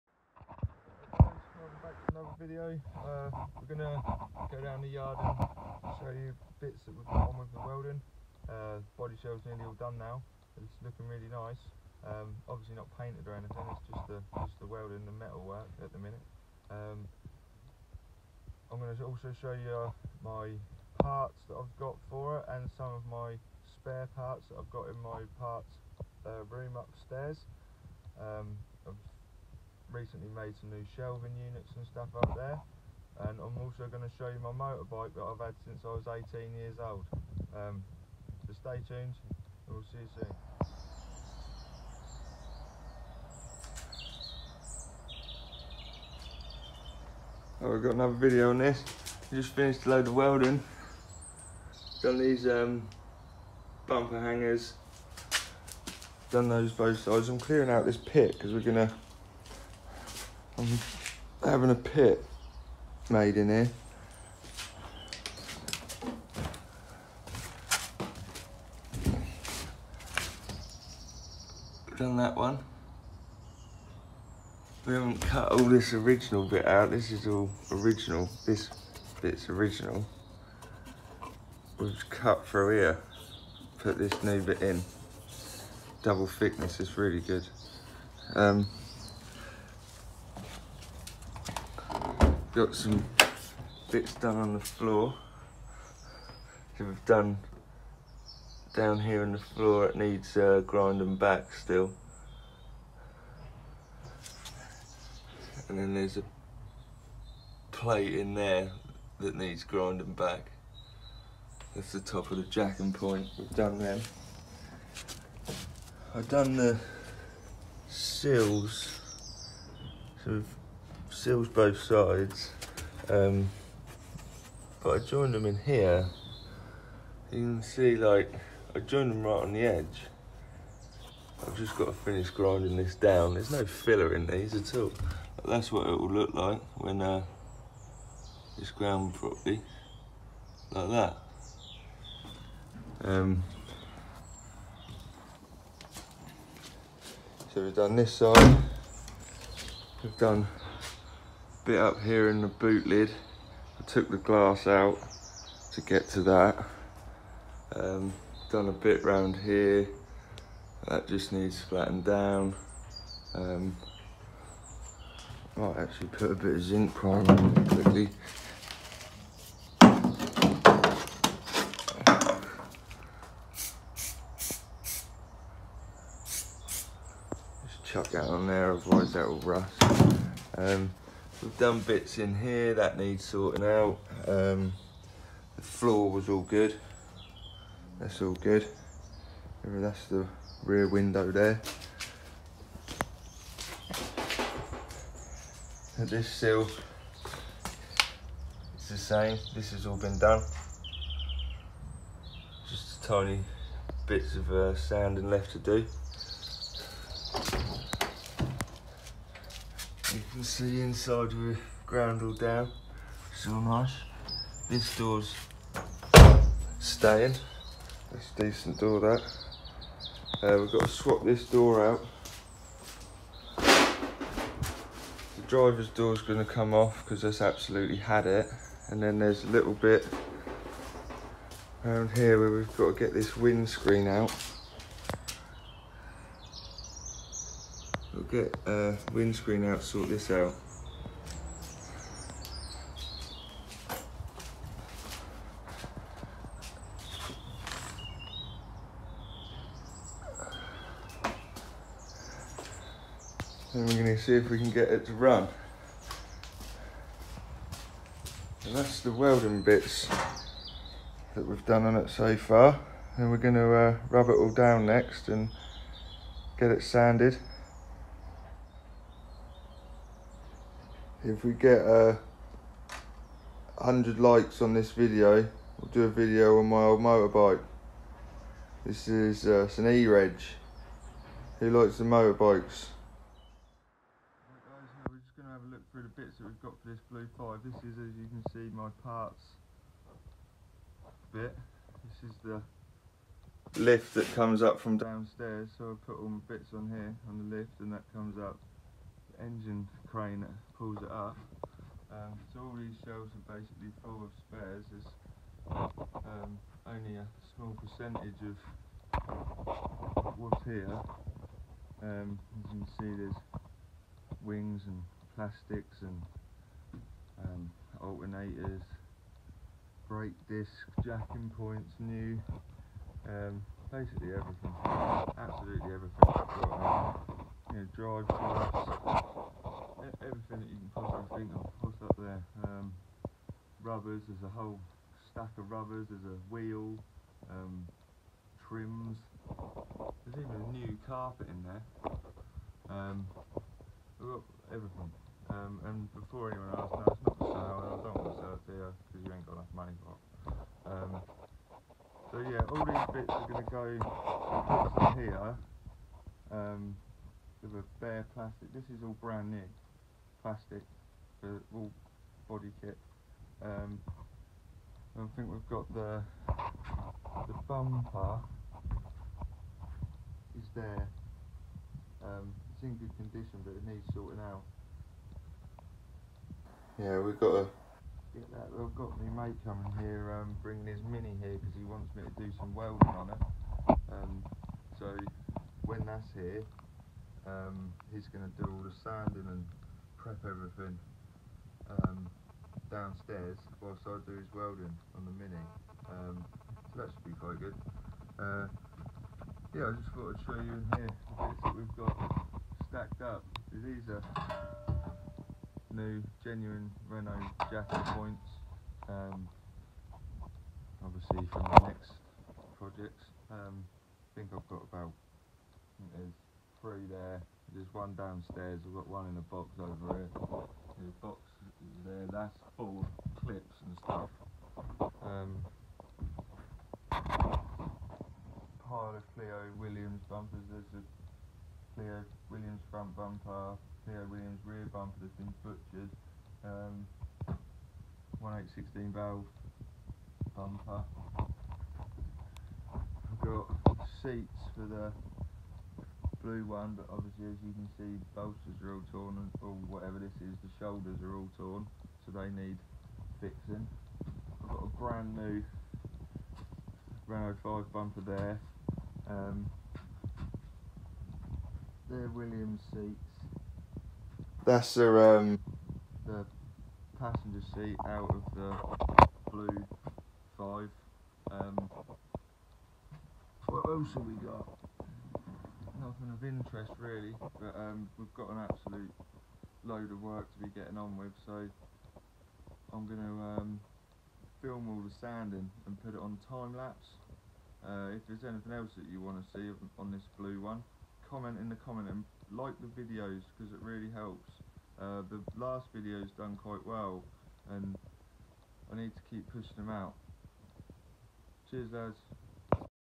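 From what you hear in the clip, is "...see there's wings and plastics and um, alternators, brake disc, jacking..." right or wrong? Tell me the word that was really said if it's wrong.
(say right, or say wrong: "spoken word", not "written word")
right.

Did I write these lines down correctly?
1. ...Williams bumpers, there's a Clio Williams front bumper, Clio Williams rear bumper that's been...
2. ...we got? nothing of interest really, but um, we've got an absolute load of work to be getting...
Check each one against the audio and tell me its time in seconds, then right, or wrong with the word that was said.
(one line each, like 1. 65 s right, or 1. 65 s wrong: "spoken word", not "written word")
1. 429 s right
2. 474 s right.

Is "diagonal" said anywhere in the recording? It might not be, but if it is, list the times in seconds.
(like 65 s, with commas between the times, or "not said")
not said.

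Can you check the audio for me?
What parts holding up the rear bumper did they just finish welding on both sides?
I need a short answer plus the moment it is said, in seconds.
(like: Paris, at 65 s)
bumper hangers, at 53 s.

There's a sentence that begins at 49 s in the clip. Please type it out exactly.
Just finished a load of welding.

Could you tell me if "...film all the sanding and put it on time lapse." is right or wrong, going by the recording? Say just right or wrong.
right.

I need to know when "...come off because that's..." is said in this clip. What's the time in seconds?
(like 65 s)
226 s.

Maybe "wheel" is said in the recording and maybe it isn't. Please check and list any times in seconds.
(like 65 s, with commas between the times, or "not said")
336 s.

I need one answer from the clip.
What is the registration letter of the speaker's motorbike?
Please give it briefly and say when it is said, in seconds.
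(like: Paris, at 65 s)
E-Reg, at 279 s.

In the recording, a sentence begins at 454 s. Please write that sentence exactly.
I've got a brand new Renault 5 bumper there.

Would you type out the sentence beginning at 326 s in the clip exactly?
Um, you know, drive shafts, everything that you can possibly think of puts up there.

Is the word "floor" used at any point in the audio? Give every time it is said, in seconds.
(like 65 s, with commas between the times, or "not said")
94 s, 99 s, 185 s.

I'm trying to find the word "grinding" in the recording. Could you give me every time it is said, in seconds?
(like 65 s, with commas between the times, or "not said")
100 s, 109 s, 132 s.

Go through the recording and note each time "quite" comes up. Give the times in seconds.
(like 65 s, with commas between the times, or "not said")
397 s, 496 s.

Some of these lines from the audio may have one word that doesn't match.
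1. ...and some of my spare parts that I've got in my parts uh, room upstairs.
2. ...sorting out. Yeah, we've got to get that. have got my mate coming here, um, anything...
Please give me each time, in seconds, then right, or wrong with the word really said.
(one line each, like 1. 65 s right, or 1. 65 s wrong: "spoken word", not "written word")
1. 22 s right
2. 374 s wrong: "bringing", not "anything".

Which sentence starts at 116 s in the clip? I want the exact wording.
I've done the sills, so we've sills both sides.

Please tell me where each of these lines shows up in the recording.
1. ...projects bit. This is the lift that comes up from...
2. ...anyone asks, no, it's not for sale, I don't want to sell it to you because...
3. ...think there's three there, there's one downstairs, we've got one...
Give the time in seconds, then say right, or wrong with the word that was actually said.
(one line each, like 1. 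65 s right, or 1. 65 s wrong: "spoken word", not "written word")
1. 289 s wrong: "parts", not "projects"
2. 346 s right
3. 415 s right.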